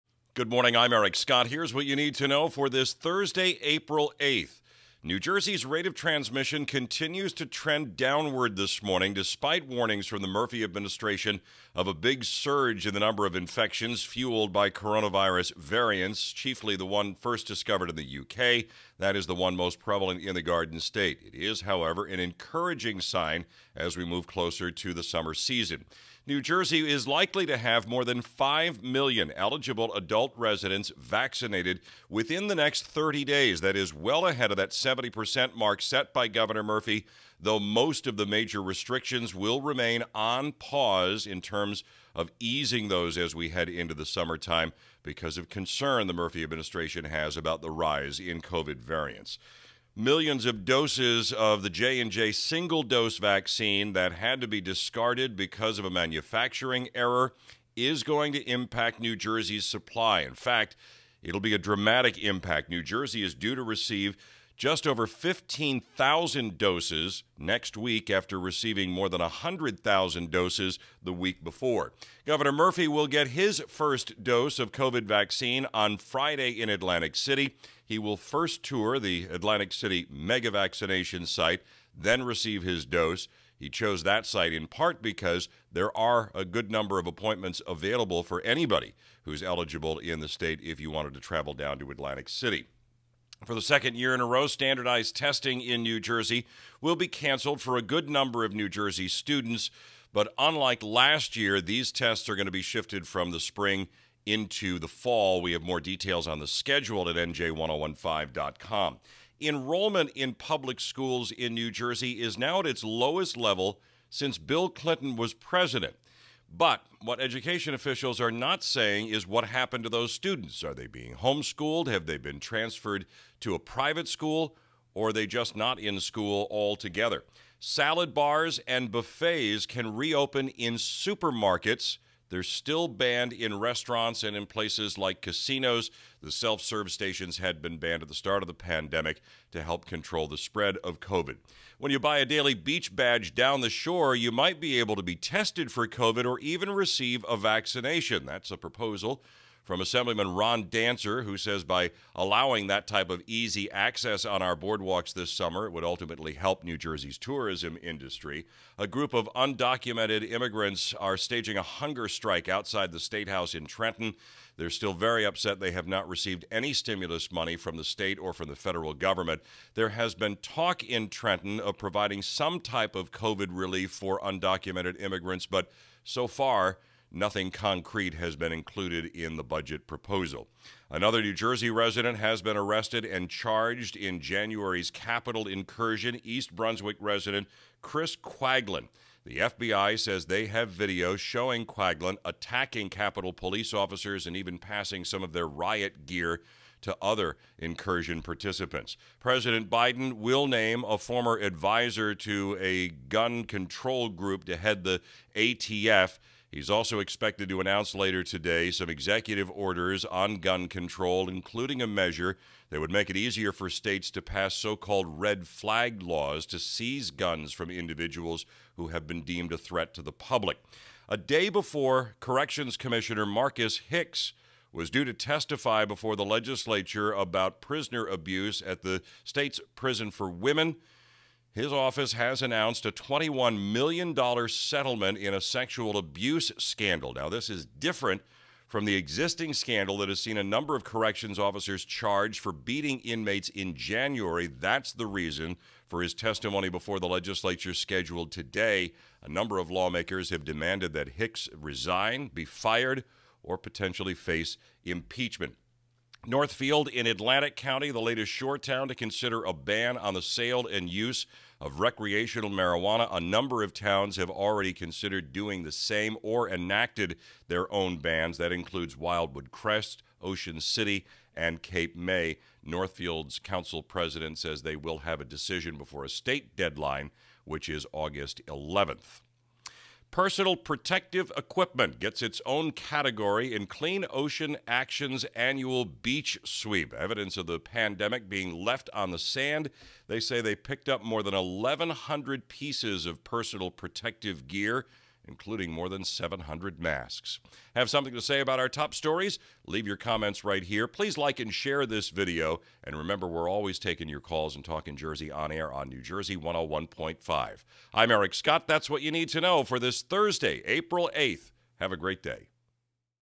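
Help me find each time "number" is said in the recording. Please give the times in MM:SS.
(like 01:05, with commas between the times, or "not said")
00:13, 01:26, 01:38, 04:00, 04:09, 04:23.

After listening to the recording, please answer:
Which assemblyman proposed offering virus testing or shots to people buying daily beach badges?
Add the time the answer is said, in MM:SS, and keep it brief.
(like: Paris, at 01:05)
Ron Dancer, at 02:30.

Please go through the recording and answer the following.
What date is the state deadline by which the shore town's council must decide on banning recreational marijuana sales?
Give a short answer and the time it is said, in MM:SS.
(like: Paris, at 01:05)
August 11th, at 04:37.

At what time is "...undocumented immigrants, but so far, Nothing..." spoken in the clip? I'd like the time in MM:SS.
02:54.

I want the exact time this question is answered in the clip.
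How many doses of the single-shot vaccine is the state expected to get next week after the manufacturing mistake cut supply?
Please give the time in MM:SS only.
01:04.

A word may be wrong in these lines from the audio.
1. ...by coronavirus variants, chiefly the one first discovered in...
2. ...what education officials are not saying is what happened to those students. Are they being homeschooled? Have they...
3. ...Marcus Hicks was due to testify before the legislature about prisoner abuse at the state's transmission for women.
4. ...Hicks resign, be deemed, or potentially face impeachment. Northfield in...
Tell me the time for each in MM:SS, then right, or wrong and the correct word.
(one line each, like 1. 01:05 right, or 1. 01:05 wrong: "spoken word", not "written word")
1. 00:14 right
2. 01:57 right
3. 03:43 wrong: "prison", not "transmission"
4. 04:11 wrong: "fired", not "deemed".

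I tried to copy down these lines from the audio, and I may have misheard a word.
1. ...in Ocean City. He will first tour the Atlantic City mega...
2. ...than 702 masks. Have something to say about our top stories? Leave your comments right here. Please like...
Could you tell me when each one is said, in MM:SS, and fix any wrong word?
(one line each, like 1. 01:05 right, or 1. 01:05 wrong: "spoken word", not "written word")
1. 01:16 wrong: "Atlantic", not "Ocean"
2. 04:55 wrong: "700", not "702".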